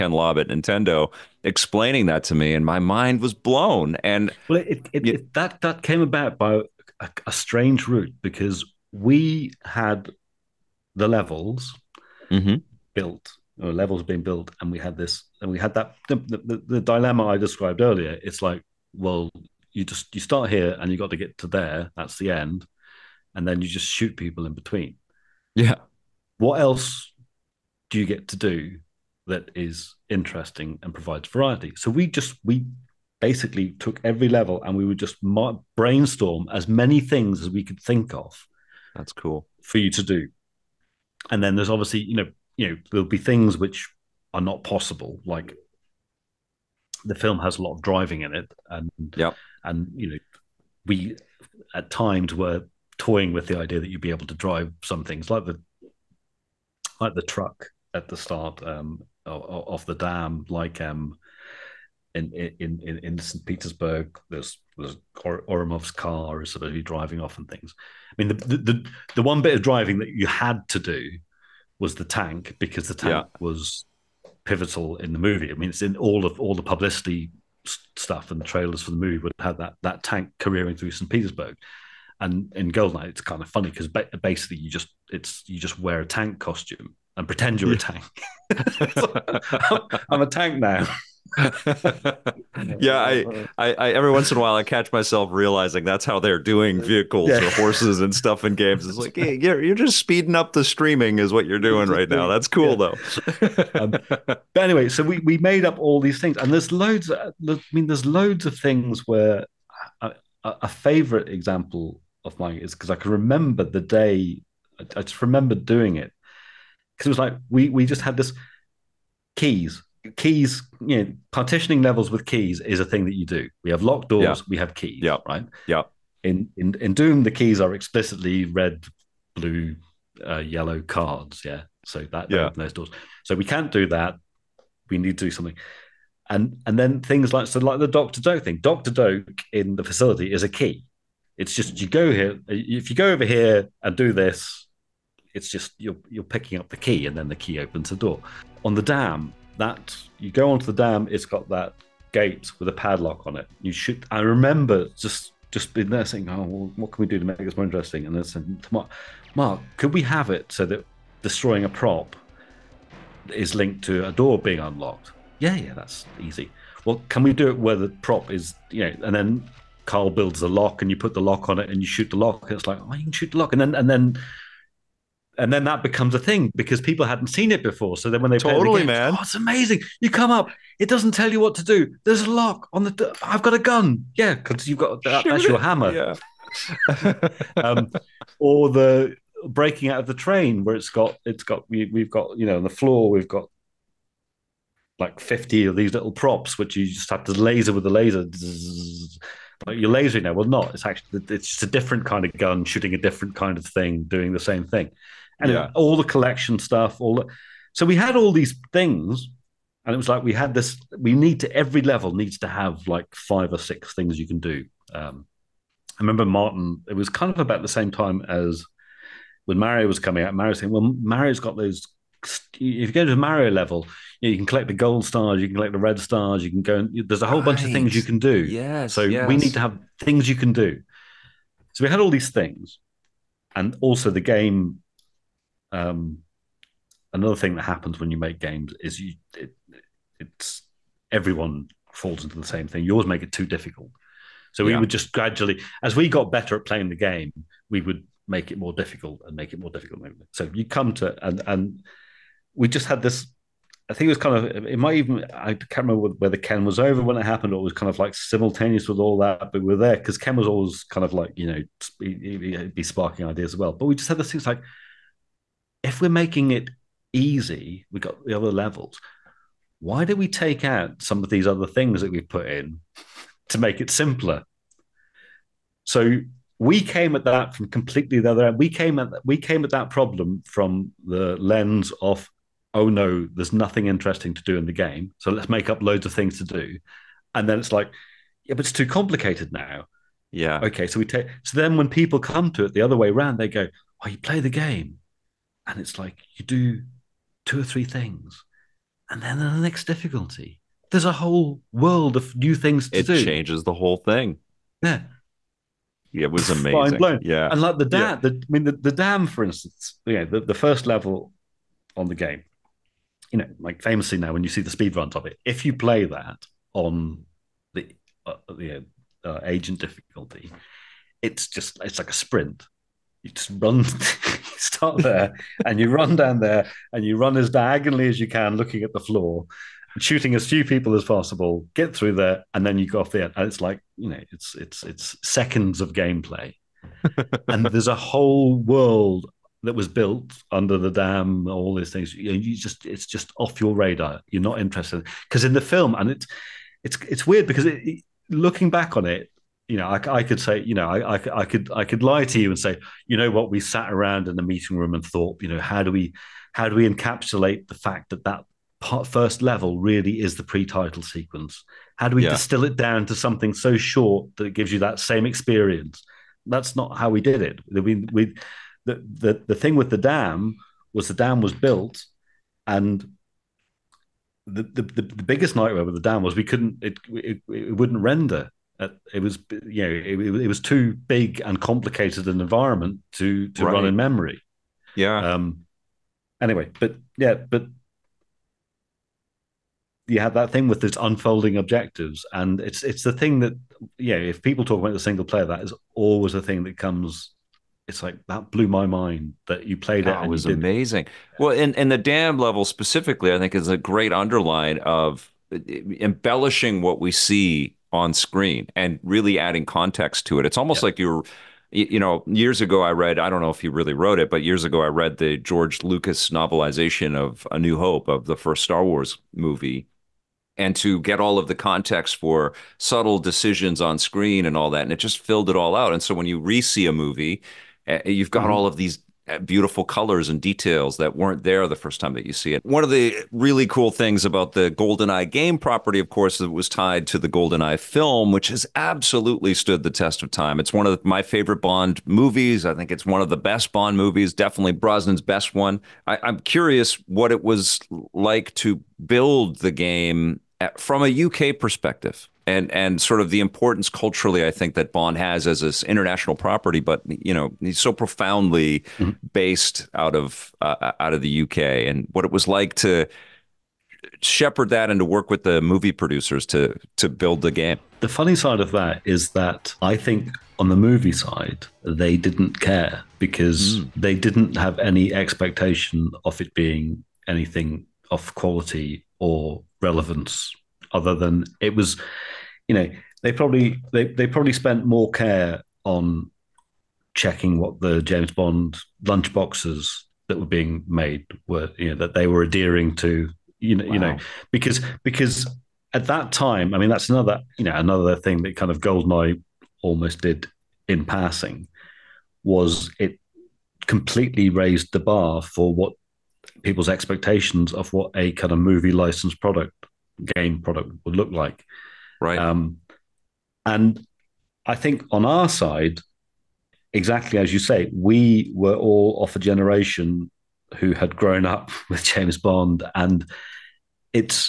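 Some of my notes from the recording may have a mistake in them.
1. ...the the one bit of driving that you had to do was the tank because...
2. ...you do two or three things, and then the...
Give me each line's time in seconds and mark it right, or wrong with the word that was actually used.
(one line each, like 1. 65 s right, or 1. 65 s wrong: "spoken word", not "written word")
1. 68 s right
2. 296 s right.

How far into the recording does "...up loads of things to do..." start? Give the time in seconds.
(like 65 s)
285 s.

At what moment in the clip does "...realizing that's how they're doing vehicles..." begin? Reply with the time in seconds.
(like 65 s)
95 s.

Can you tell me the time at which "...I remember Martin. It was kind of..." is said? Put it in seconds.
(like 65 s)
215 s.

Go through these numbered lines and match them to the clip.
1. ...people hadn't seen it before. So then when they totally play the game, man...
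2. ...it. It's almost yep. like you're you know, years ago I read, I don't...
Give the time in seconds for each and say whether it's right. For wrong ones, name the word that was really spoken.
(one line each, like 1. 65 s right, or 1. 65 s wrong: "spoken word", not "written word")
1. 176 s right
2. 410 s right.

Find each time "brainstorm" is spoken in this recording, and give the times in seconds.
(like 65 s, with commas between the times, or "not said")
35 s.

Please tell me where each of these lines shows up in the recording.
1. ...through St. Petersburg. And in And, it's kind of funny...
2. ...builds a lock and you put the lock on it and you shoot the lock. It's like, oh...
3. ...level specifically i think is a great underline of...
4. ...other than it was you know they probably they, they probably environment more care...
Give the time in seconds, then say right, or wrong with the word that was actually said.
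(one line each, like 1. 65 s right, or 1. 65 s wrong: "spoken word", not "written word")
1. 80 s wrong: "Goldeneye", not "And"
2. 170 s right
3. 402 s right
4. 480 s wrong: "spent", not "environment".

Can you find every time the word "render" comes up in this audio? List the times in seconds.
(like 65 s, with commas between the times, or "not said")
378 s.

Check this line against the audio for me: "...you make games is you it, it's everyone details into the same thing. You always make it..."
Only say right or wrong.
wrong.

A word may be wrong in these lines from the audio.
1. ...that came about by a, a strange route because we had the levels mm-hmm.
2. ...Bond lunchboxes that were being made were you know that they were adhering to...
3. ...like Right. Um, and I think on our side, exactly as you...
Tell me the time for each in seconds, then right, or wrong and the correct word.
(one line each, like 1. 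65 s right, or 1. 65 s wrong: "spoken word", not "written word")
1. 5 s right
2. 488 s right
3. 511 s right.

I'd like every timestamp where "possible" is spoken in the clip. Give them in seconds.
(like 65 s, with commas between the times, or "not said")
44 s, 331 s.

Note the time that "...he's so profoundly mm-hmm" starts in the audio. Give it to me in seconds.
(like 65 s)
457 s.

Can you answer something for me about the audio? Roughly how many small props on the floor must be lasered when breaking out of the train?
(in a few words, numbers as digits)
50.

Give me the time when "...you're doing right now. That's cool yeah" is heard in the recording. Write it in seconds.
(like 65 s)
101 s.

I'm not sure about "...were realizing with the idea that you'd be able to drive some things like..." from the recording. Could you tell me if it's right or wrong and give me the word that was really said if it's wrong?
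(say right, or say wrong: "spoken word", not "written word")
wrong: "toying", not "realizing".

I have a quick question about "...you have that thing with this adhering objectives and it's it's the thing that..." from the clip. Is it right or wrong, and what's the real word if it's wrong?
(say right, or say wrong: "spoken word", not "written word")
wrong: "unfolding", not "adhering".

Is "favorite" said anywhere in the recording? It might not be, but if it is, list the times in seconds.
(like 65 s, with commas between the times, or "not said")
110 s, 441 s.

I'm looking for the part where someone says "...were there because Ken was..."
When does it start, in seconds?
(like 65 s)
259 s.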